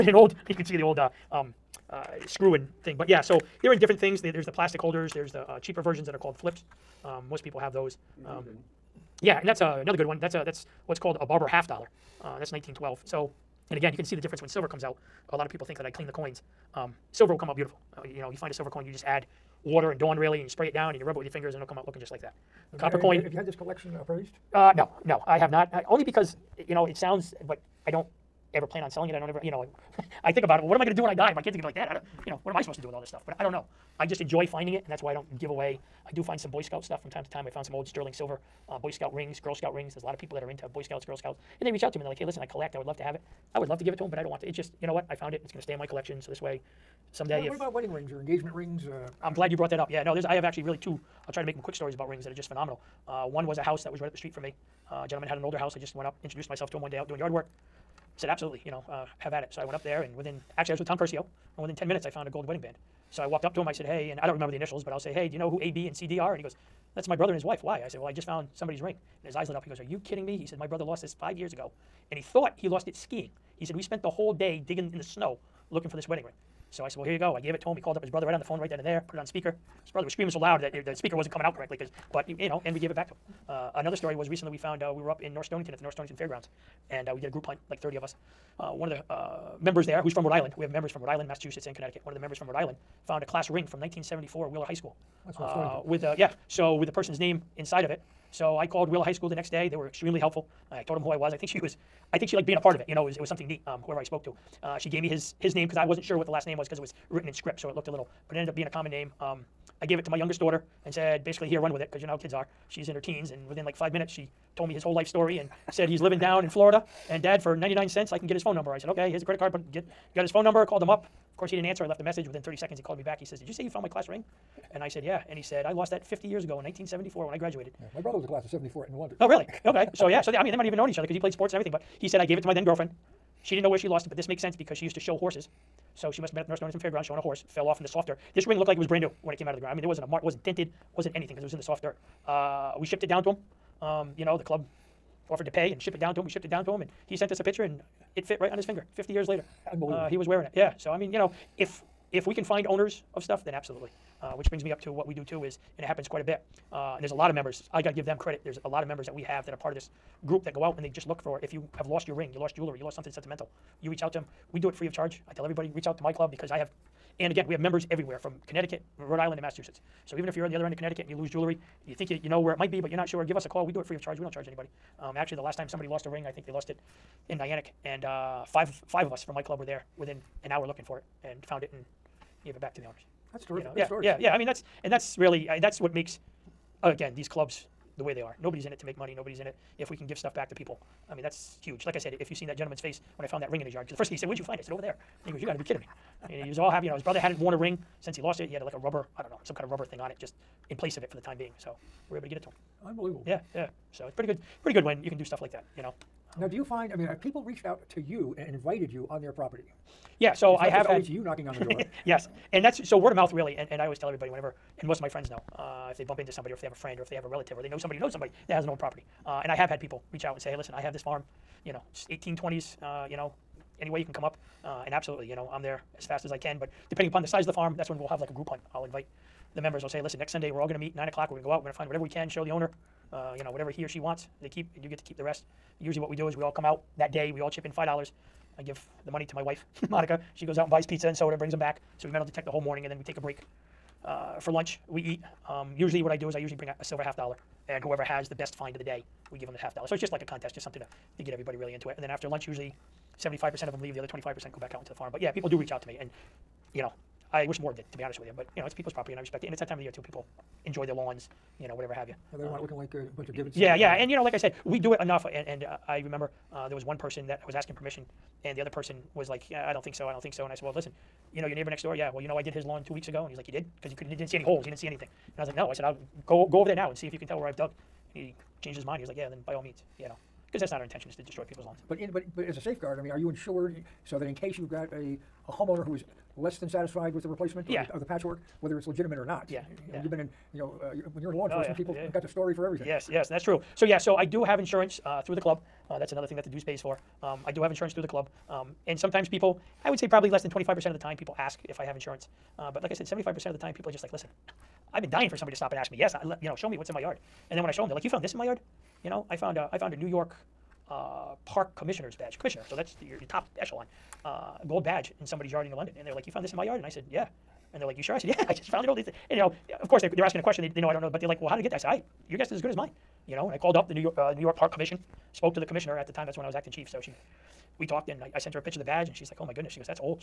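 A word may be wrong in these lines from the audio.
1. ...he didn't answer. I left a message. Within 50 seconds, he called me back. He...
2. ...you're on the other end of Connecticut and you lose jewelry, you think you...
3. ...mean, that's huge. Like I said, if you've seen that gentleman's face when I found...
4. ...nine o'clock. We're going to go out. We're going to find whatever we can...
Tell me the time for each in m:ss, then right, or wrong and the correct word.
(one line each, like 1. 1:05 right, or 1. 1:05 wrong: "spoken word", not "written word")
1. 2:01 wrong: "30", not "50"
2. 2:50 right
3. 3:11 right
4. 3:50 right.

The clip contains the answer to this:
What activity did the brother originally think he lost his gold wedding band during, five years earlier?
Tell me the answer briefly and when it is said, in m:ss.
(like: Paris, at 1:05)
Skiing, at 1:12.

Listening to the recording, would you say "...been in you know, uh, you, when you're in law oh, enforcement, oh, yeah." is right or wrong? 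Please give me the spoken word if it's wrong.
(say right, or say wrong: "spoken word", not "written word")
right.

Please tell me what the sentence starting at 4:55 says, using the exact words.
Uh, that's another thing that the dues pays for.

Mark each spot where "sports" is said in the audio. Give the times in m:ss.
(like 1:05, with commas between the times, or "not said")
2:11.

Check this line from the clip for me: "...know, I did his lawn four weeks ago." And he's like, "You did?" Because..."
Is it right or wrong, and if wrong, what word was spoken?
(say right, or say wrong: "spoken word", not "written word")
wrong: "two", not "four".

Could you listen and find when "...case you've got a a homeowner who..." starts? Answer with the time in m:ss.
4:44.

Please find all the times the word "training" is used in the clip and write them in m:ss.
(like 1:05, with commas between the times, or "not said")
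not said.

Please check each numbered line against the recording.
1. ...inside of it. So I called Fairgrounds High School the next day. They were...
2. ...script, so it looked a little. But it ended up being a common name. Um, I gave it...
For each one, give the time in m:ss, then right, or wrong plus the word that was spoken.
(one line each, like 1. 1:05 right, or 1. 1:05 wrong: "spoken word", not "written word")
1. 1:37 wrong: "Wheeler", not "Fairgrounds"
2. 1:47 right.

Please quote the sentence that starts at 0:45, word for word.
It's going to stay in my collection.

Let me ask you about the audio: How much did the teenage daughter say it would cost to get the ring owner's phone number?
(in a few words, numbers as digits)
99 cents.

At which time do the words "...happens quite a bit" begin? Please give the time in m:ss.
2:35.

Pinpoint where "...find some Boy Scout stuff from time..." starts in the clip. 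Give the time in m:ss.
0:36.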